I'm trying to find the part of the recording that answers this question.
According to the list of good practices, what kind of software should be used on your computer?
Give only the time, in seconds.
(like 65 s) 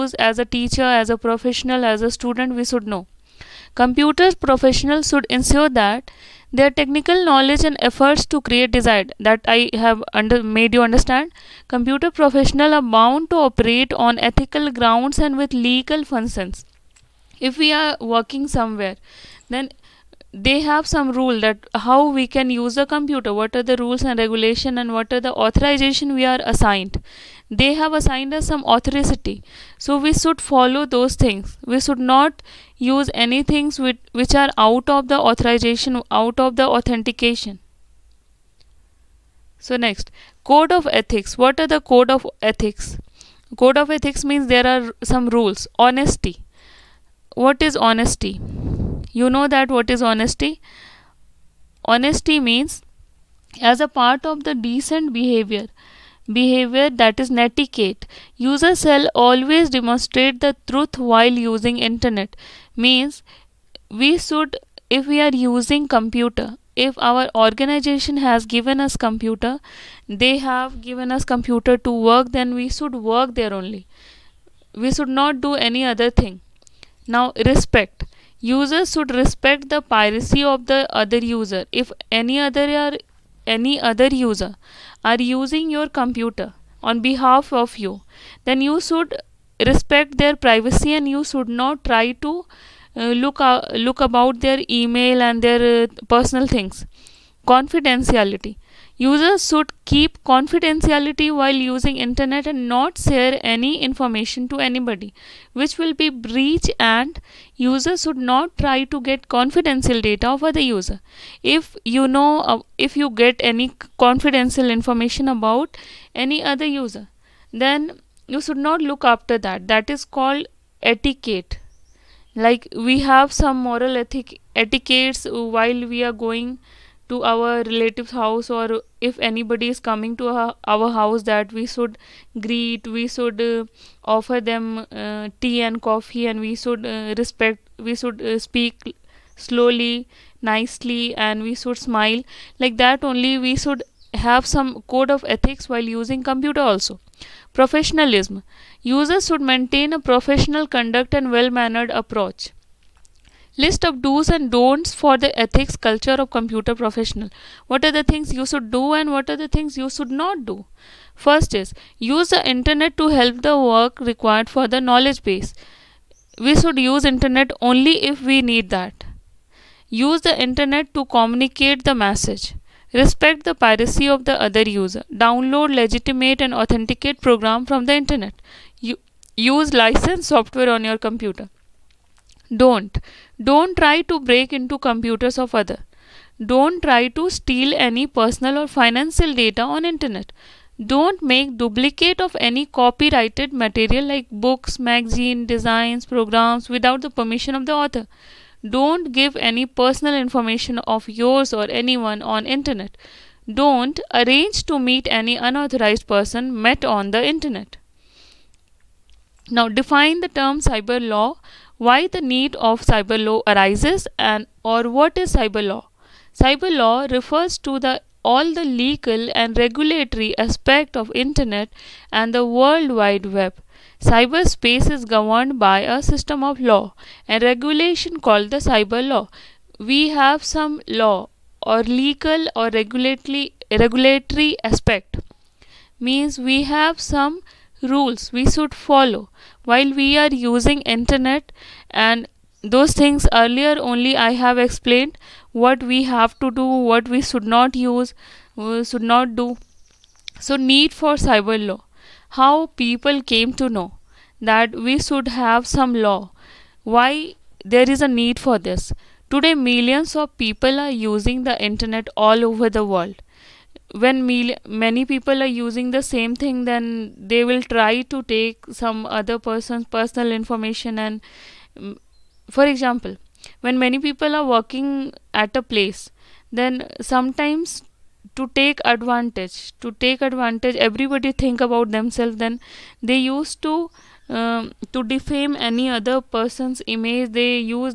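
179 s.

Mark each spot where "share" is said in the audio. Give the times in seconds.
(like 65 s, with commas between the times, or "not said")
103 s.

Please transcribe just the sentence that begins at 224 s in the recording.
Cyberspace is governed by a system of law and regulation called the cyber law.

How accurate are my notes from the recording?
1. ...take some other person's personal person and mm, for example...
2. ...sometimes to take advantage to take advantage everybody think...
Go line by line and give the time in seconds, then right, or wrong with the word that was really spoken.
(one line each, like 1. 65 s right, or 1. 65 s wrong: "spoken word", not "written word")
1. 268 s wrong: "information", not "person"
2. 277 s right.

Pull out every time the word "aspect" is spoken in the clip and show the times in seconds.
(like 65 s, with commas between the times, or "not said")
220 s, 234 s.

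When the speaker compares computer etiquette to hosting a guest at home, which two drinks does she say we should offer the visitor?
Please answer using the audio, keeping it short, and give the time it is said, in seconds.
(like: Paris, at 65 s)
tea and coffee, at 135 s.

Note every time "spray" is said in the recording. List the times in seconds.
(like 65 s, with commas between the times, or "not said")
not said.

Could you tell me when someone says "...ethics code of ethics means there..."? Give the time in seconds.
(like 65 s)
42 s.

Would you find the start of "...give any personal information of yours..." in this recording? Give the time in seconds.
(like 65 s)
199 s.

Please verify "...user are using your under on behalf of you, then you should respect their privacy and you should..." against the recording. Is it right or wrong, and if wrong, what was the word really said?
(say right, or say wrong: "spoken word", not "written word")
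wrong: "computer", not "under".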